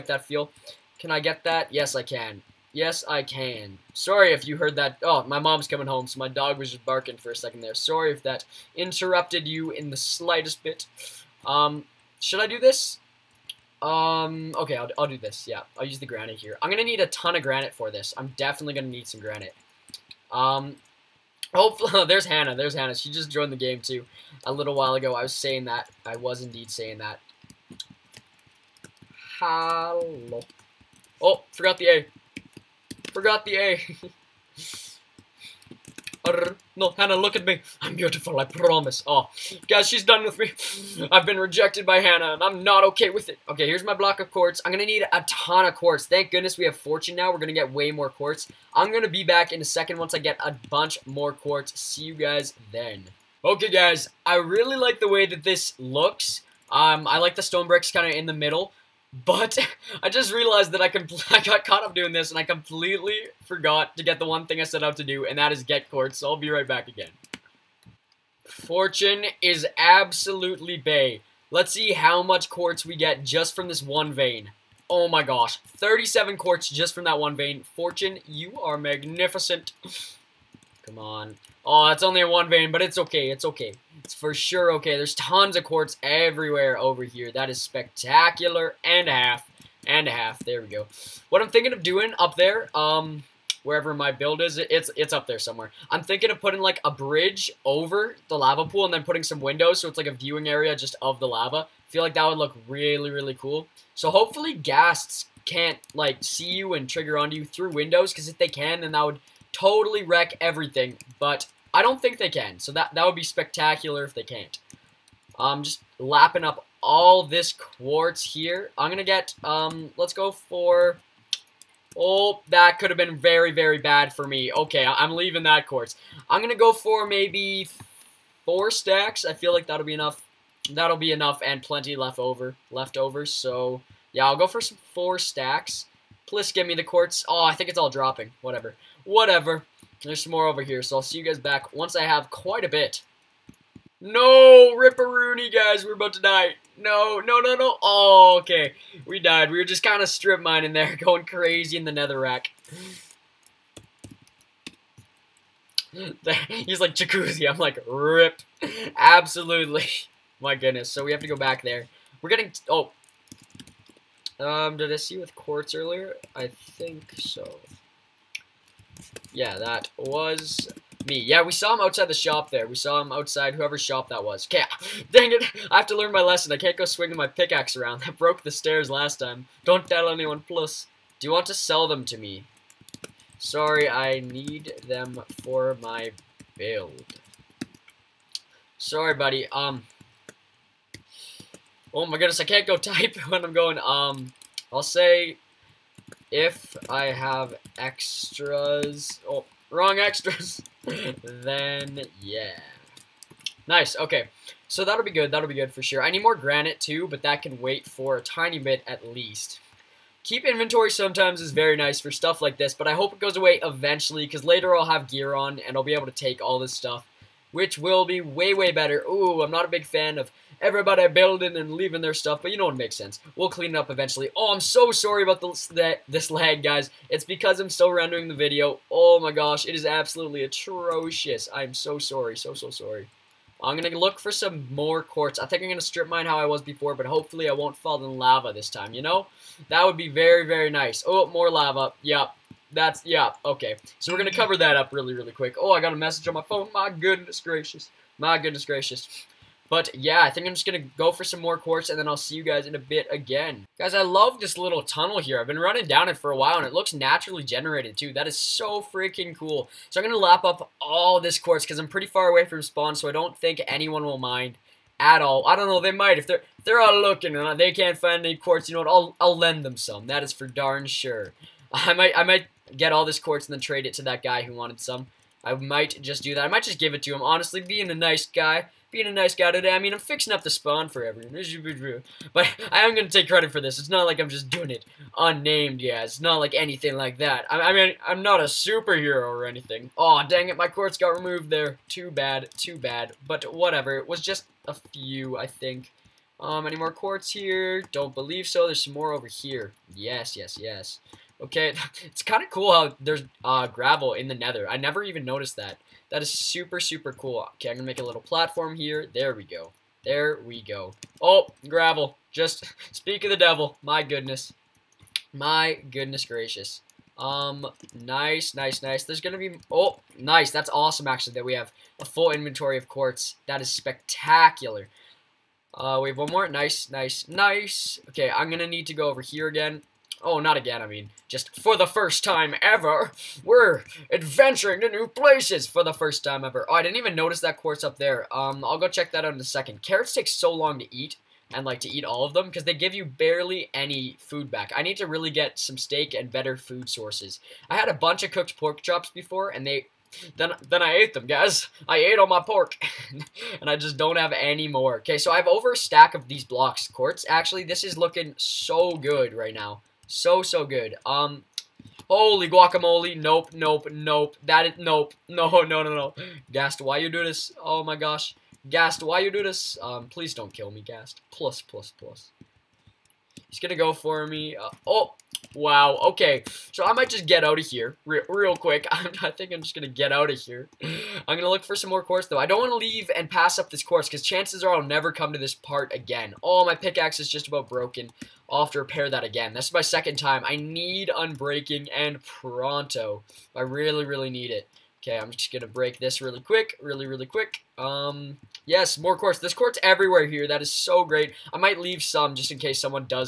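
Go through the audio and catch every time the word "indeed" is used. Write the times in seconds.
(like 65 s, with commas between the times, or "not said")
26 s.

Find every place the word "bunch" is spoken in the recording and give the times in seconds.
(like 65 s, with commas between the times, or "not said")
50 s, 347 s.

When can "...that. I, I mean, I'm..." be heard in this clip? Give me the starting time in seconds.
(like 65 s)
287 s.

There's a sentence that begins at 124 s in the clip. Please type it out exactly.
Okay, I am leaving that quartz.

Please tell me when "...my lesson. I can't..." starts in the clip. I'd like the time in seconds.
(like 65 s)
176 s.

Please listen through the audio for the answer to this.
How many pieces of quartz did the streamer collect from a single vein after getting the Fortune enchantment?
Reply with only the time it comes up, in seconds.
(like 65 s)
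75 s.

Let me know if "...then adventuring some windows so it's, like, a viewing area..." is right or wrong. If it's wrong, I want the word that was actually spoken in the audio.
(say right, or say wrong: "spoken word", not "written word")
wrong: "putting", not "adventuring".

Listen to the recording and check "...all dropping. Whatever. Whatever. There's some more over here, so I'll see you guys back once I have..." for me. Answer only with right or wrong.
right.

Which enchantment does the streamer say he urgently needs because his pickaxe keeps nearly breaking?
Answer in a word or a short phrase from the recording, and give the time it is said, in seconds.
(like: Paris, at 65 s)
Unbreaking, at 391 s.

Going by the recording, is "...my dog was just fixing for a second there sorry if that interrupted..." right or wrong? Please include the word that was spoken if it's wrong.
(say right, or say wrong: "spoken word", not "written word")
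wrong: "barking", not "fixing".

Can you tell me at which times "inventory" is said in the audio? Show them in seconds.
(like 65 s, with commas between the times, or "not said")
210 s, 322 s.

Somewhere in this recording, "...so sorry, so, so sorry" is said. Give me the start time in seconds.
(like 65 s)
231 s.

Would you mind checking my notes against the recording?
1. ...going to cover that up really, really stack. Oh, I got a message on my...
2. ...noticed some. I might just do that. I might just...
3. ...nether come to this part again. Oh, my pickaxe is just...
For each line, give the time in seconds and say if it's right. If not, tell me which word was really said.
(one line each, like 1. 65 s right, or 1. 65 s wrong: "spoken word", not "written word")
1. 244 s wrong: "quick", not "stack"
2. 274 s wrong: "wanted", not "noticed"
3. 384 s wrong: "never", not "nether".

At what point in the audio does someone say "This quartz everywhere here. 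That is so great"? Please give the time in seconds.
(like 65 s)
399 s.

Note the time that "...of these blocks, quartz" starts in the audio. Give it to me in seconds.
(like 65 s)
356 s.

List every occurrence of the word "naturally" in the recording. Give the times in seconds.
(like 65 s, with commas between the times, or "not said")
256 s.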